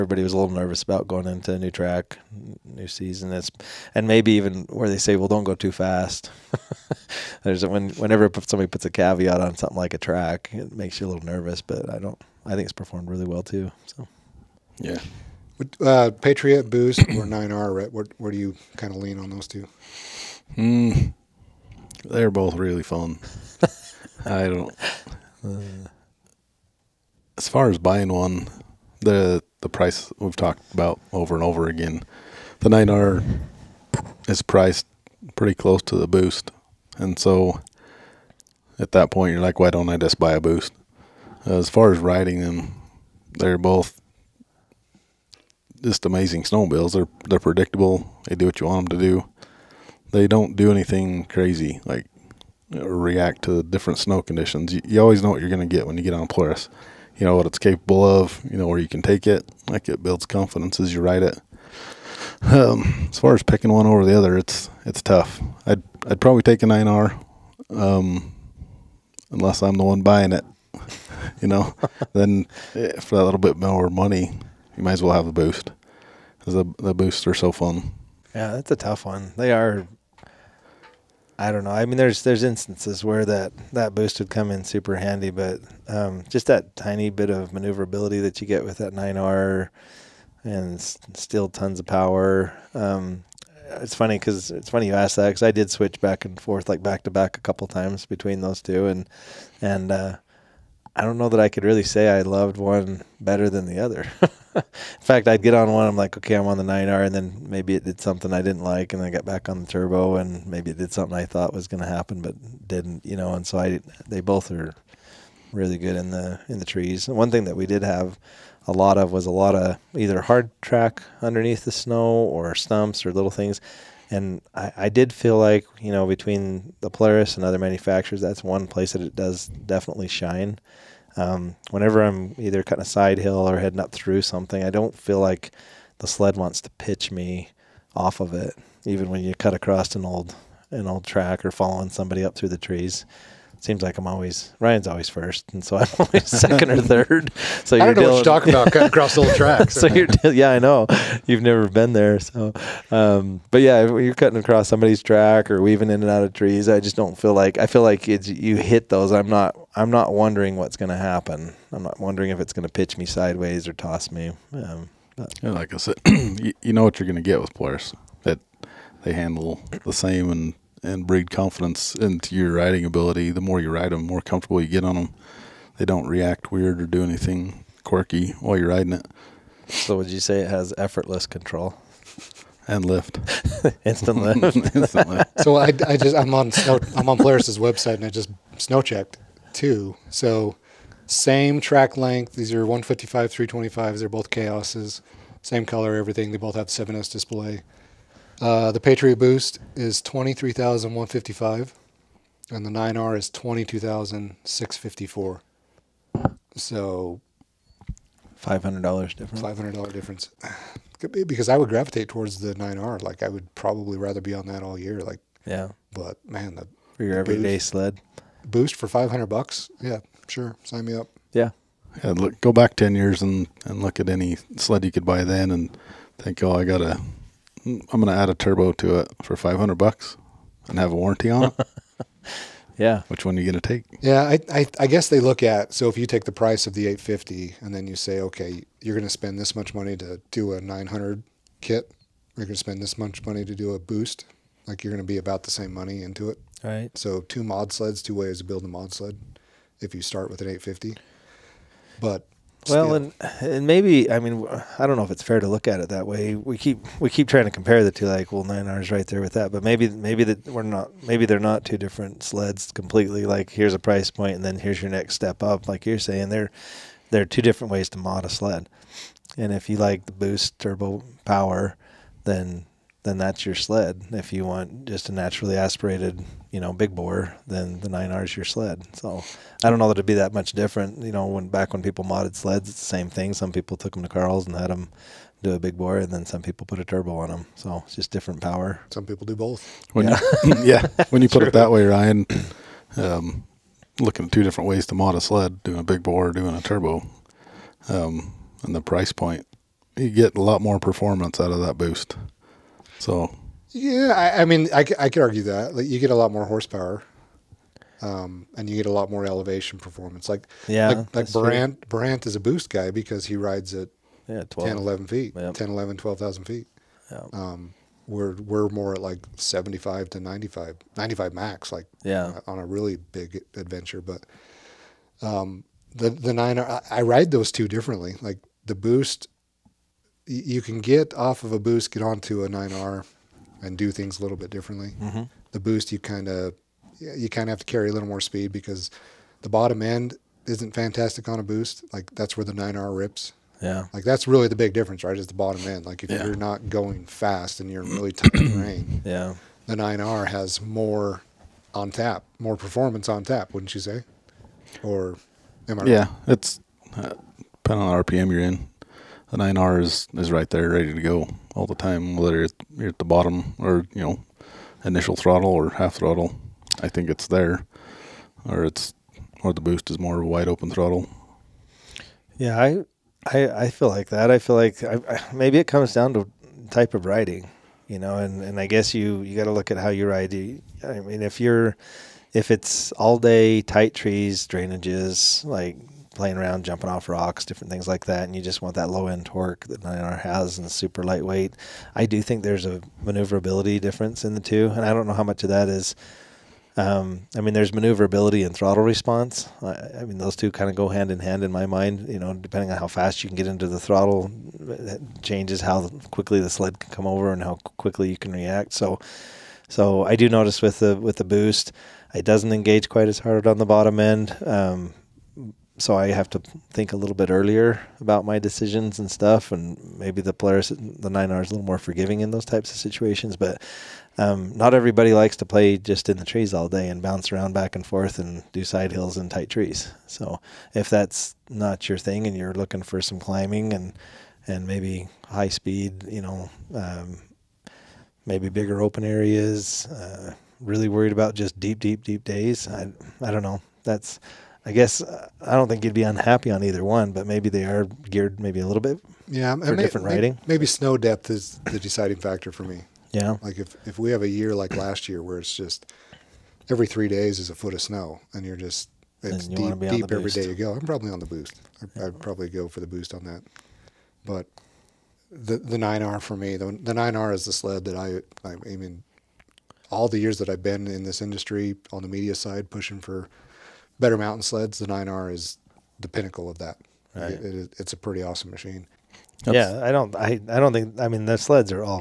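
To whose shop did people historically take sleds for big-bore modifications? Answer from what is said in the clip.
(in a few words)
Carl's.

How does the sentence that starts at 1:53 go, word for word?
And so I, they both are really good in the in the trees.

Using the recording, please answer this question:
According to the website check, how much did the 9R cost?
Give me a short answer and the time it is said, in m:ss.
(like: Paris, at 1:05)
$22,654, at 3:23.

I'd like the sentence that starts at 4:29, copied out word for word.
And if you like the boost turbo power, then then that's your sled.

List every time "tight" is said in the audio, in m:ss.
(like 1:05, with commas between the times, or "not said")
5:48, 6:23, 7:09.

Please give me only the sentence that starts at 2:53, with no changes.
The more you ride them, the more comfortable you get on them.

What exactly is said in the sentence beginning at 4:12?
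But well, and and maybe I mean I don't know if it's fair to look at it that way.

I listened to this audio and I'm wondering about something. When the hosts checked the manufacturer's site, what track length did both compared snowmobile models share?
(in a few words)
155.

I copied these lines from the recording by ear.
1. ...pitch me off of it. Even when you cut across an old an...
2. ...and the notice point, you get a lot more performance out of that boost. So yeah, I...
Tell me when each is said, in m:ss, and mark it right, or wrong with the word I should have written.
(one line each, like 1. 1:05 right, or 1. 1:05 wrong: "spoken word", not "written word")
1. 2:16 right
2. 4:58 wrong: "price", not "notice".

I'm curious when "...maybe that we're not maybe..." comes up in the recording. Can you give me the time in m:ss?
4:19.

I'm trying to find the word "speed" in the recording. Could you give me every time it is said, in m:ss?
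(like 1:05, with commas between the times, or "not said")
5:38, 7:15.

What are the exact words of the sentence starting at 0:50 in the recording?
They don't do anything crazy like react to different snow conditions.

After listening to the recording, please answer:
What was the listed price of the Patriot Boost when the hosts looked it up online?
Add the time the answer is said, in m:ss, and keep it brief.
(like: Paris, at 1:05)
$23,155, at 3:20.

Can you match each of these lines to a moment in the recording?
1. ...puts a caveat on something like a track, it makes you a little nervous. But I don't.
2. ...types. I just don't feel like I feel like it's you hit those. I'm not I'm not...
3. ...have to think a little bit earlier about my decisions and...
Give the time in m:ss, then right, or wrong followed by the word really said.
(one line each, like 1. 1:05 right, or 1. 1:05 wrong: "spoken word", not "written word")
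1. 0:08 right
2. 2:36 wrong: "trees", not "types"
3. 6:56 right.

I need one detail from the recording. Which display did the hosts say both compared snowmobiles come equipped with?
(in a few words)
7S.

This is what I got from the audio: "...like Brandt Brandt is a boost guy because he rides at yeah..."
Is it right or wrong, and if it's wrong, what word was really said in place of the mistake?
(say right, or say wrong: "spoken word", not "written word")
right.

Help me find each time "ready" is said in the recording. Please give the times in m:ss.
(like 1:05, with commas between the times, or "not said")
6:00.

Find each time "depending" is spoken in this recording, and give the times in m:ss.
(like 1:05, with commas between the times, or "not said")
5:57, 6:42.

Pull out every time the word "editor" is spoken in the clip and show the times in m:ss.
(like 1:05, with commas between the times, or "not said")
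not said.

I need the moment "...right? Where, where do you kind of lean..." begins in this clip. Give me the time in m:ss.
0:17.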